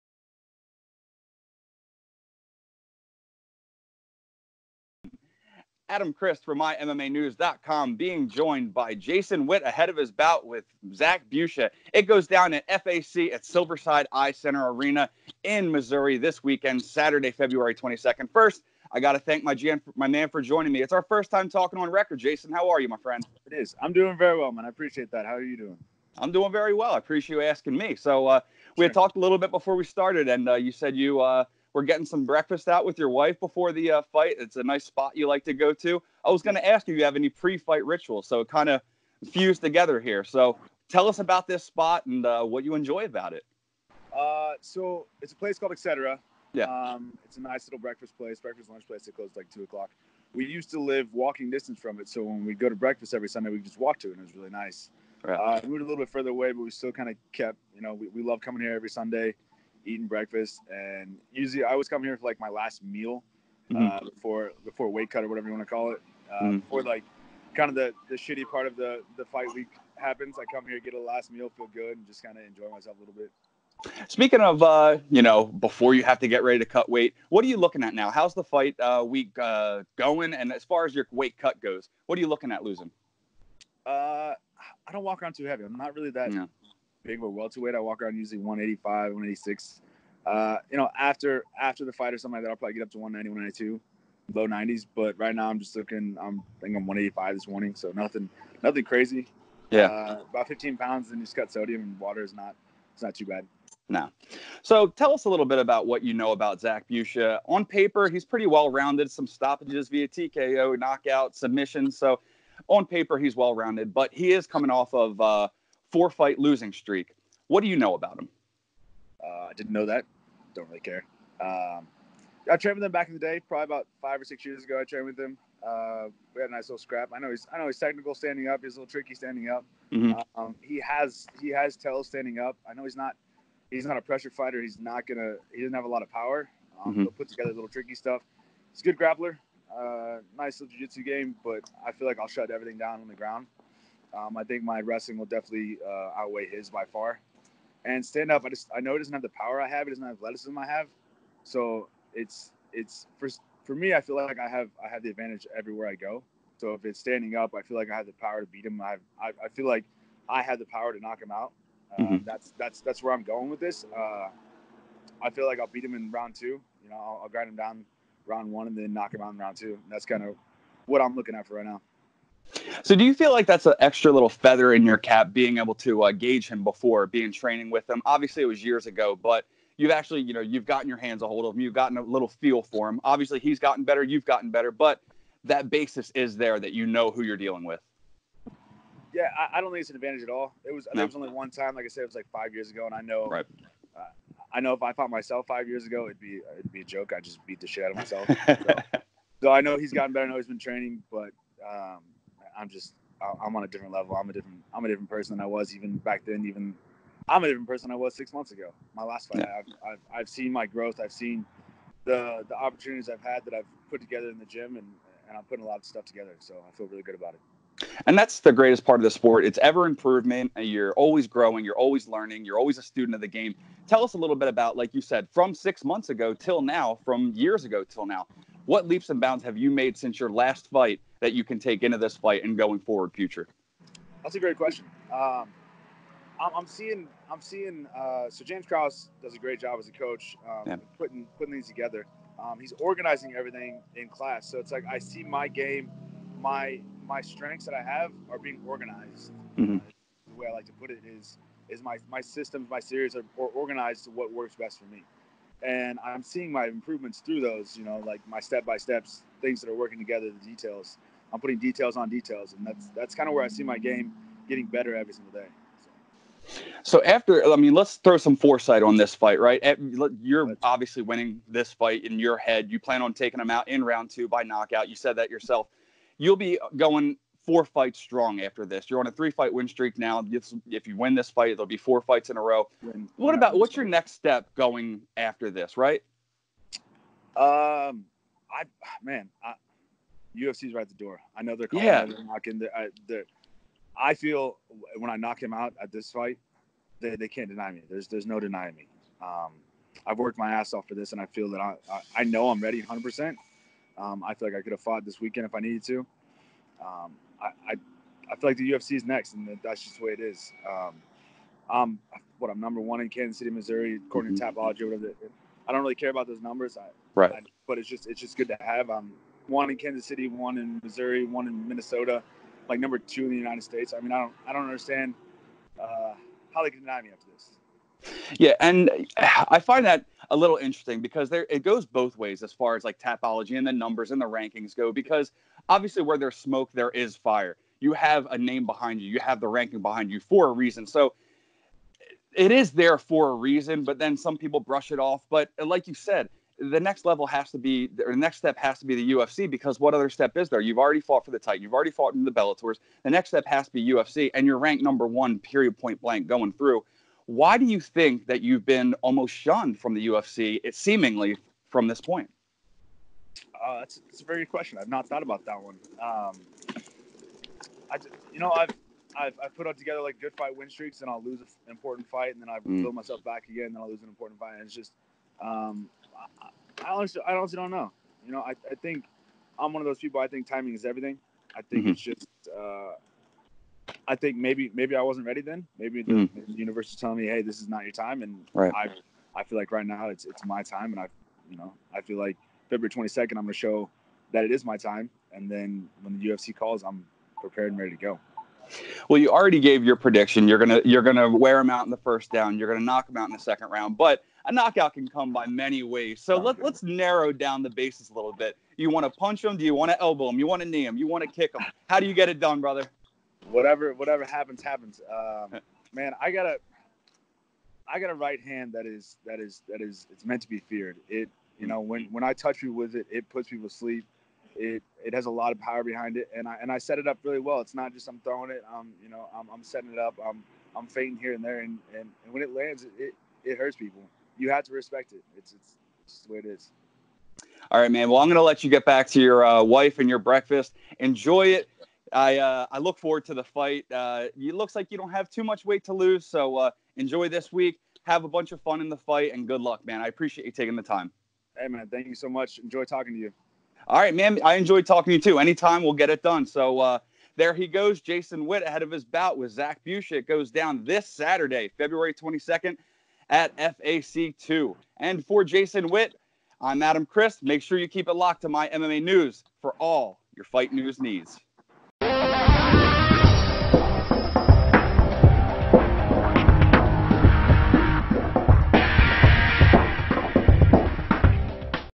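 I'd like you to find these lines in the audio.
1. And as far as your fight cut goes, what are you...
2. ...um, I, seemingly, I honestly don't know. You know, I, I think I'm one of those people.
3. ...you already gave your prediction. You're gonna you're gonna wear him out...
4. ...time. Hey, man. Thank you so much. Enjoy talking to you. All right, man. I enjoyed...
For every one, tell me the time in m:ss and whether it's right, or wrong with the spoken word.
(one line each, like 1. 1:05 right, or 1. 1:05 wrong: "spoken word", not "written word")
1. 1:20 wrong: "weight", not "fight"
2. 6:15 wrong: "honestly", not "seemingly"
3. 6:39 right
4. 7:30 right.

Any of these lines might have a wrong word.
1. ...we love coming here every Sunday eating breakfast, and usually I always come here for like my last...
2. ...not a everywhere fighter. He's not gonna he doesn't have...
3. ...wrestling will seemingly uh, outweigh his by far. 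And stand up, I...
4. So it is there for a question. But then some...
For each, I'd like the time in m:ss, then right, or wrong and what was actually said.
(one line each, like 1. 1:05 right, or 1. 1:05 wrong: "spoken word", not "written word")
1. 0:58 right
2. 2:13 wrong: "pressure", not "everywhere"
3. 2:24 wrong: "definitely", not "seemingly"
4. 5:40 wrong: "reason", not "question".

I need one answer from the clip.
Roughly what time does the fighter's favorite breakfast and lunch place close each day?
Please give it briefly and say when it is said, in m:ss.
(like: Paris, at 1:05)
2 o'clock, at 0:49.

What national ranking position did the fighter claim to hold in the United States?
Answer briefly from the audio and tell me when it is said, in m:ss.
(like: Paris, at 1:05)
Number 2, at 5:22.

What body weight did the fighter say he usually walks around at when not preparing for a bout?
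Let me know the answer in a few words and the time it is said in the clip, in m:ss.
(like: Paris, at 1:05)
185, 186, at 1:28.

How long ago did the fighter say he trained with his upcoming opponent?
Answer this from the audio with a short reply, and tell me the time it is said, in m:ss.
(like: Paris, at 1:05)
5 or 6 years, at 2:04.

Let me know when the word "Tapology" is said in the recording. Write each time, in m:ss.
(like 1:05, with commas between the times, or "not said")
5:14, 5:32.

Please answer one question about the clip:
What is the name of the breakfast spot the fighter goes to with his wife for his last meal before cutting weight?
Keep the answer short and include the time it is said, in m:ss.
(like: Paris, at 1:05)
Etc, at 0:45.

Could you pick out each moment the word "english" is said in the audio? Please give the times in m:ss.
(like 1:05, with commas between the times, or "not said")
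not said.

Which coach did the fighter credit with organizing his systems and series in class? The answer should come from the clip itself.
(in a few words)
James Krause.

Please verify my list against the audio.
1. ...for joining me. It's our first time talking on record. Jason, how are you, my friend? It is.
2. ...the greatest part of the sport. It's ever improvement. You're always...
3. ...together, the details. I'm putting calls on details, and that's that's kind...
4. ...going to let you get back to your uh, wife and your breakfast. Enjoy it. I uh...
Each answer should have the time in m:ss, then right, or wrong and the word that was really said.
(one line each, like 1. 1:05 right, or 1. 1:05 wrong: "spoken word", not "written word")
1. 0:20 right
2. 3:38 right
3. 4:19 wrong: "details", not "calls"
4. 7:18 right.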